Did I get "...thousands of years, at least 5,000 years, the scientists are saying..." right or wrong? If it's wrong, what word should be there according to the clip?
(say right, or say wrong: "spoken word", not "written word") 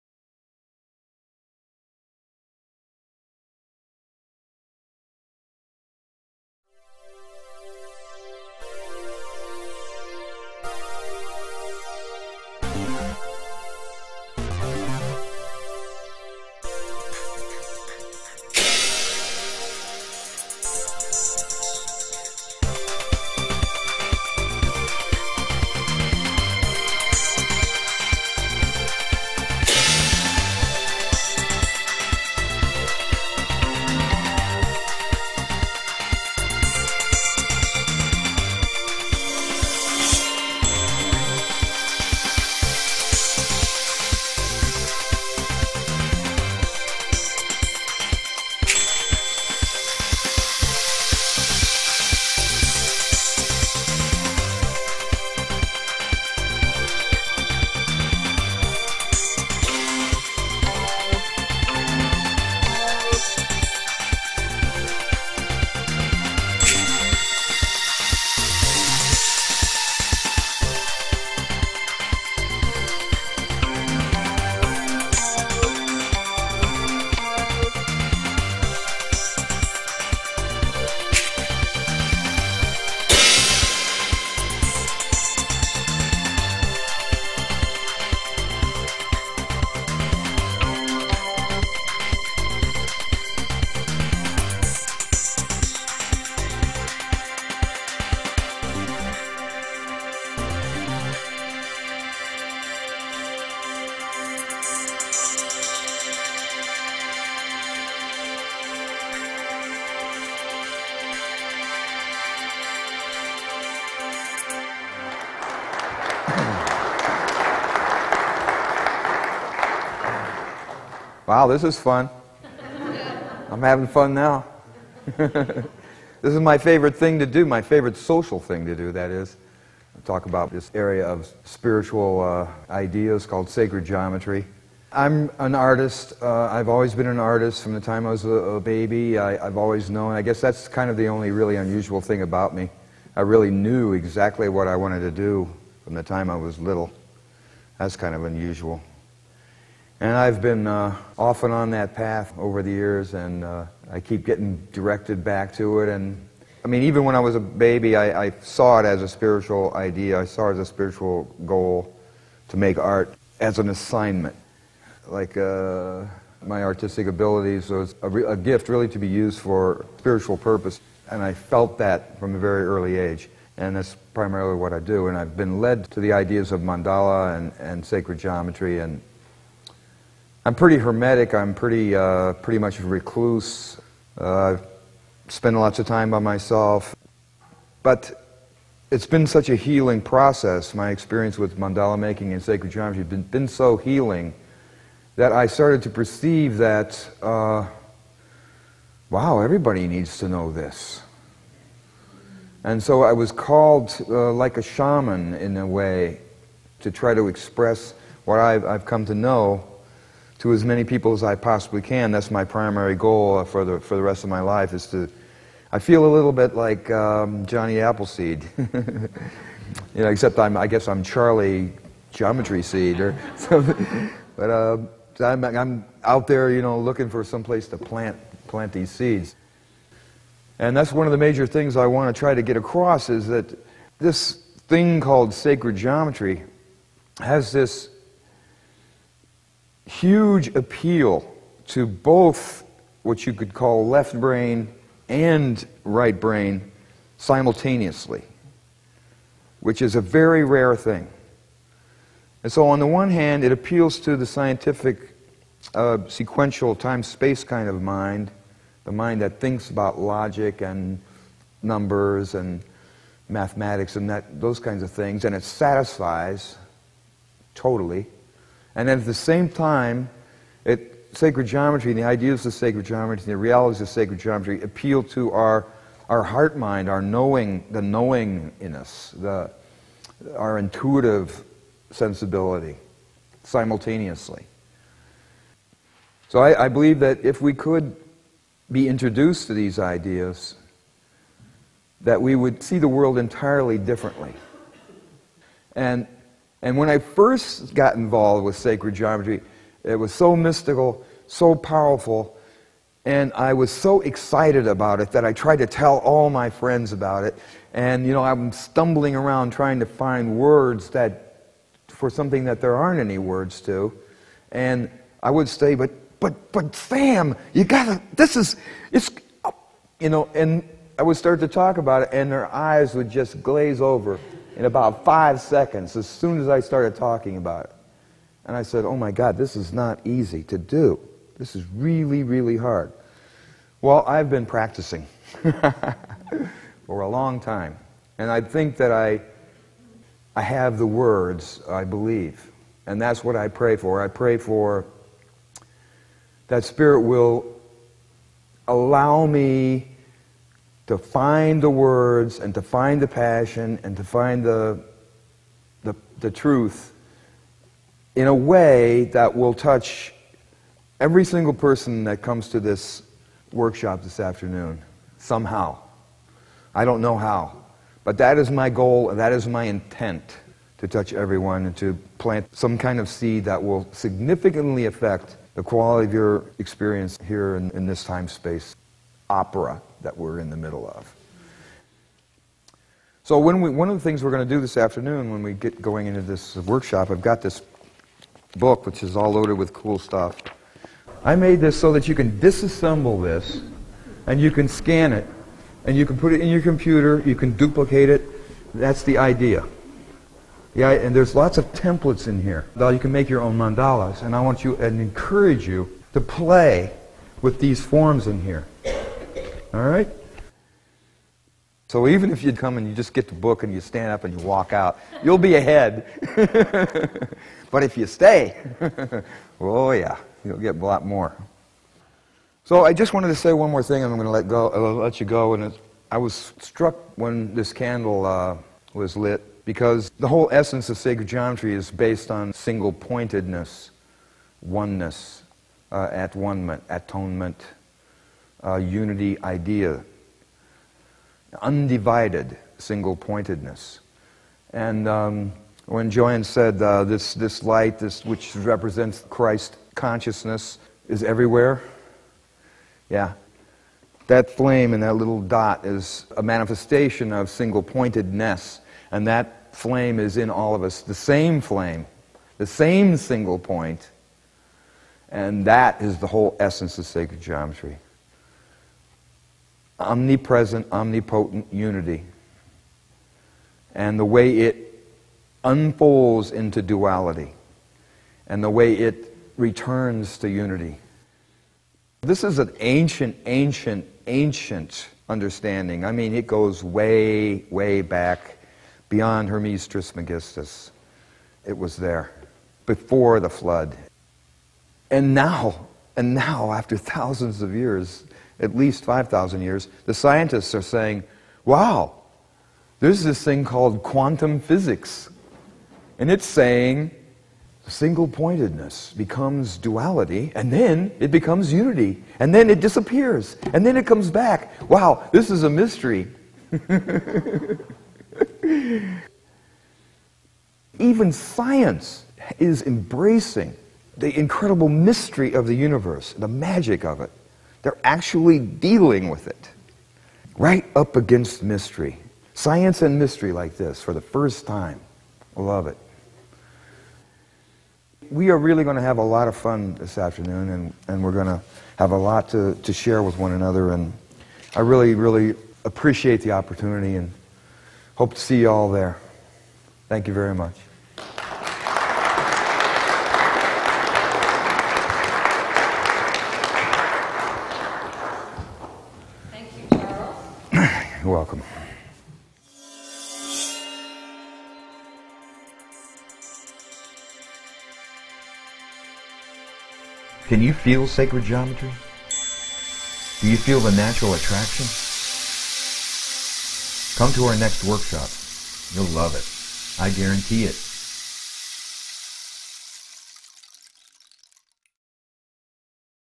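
right.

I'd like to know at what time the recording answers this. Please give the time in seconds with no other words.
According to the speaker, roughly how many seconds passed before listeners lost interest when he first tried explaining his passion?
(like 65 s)
325 s.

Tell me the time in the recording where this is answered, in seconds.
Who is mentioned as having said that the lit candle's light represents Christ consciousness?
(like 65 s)
446 s.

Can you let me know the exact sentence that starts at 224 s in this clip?
But uh, I'm, I'm out there, you know, looking for some place to plant, plant these seeds.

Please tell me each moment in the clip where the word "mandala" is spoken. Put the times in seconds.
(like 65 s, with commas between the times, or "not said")
176 s, 191 s, 403 s.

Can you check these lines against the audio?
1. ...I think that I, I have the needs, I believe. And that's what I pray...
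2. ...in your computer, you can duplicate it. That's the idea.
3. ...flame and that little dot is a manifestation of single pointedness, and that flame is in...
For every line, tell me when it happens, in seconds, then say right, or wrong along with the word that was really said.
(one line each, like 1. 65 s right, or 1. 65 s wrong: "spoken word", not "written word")
1. 338 s wrong: "words", not "needs"
2. 396 s right
3. 454 s right.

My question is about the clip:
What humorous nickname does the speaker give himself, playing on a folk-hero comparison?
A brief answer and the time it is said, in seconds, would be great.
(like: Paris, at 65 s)
Charlie Geometry Seed, at 221 s.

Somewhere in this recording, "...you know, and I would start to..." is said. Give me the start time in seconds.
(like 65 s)
319 s.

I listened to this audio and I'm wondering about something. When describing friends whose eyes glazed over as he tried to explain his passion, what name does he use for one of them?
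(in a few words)
Sam.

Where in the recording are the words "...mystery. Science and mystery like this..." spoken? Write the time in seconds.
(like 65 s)
531 s.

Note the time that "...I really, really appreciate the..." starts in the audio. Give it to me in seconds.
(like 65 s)
544 s.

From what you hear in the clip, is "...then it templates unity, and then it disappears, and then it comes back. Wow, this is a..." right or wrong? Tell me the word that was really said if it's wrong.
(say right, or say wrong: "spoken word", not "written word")
wrong: "becomes", not "templates".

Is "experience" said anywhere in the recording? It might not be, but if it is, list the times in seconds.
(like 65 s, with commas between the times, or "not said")
190 s, 376 s.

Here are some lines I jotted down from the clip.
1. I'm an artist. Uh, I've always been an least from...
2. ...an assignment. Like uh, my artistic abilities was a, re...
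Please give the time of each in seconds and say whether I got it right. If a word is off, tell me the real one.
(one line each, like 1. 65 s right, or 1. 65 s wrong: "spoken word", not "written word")
1. 134 s wrong: "artist", not "least"
2. 163 s right.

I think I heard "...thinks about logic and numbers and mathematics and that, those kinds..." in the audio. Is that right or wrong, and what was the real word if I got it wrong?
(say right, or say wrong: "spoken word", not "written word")
right.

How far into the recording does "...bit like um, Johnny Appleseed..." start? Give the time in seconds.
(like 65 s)
216 s.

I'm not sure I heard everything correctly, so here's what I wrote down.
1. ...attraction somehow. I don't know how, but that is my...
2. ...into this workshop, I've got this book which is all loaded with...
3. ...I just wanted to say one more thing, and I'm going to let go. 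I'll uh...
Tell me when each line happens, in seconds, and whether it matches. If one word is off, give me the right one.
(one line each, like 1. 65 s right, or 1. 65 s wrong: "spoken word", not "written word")
1. 364 s wrong: "afternoon", not "attraction"
2. 386 s right
3. 422 s right.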